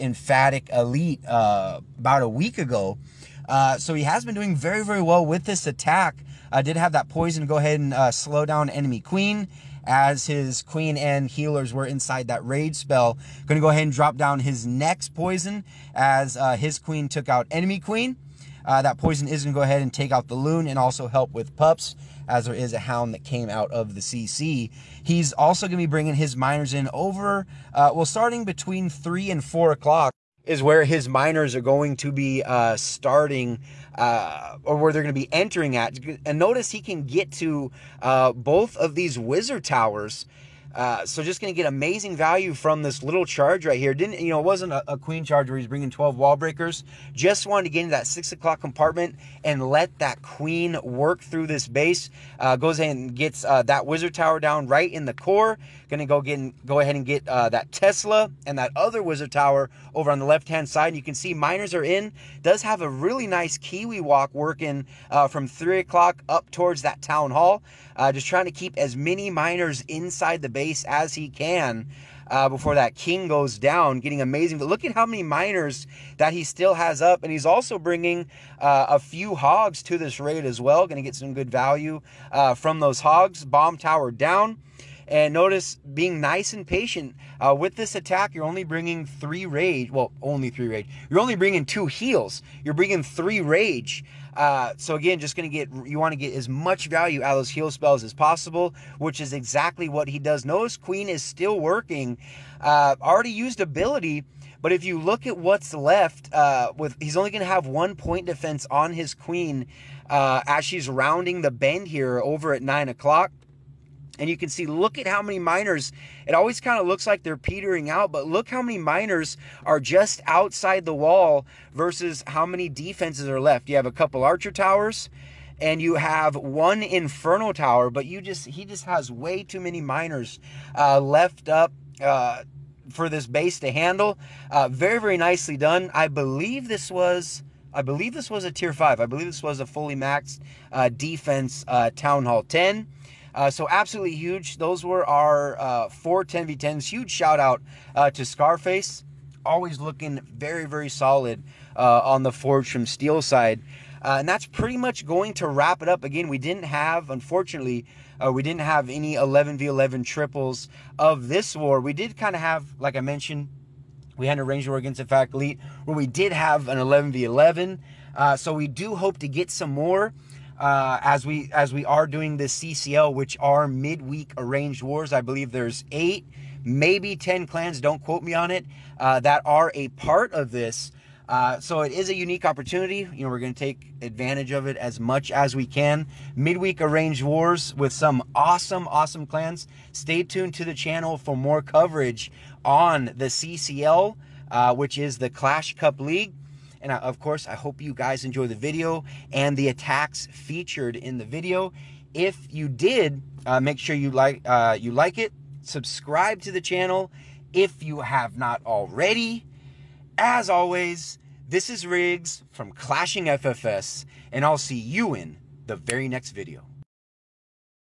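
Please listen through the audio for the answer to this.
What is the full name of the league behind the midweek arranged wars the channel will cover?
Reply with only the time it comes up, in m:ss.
3:15.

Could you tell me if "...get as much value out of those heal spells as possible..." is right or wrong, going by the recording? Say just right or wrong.
right.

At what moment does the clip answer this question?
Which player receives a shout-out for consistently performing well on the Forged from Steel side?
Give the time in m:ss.
2:28.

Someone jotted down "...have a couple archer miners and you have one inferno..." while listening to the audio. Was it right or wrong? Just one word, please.
wrong.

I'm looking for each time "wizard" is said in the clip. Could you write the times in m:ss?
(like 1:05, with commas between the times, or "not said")
0:39, 0:53, 0:59.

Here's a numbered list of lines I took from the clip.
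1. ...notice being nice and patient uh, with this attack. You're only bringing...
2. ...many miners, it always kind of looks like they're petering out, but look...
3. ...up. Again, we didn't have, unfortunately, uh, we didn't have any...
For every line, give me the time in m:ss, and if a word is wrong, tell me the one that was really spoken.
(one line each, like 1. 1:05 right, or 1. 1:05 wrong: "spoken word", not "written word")
1. 1:25 right
2. 1:55 right
3. 2:35 right.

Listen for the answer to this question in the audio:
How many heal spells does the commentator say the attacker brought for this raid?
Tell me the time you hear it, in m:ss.
1:31.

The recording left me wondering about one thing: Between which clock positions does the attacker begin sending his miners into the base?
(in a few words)
Between 3 and 4 o'clock.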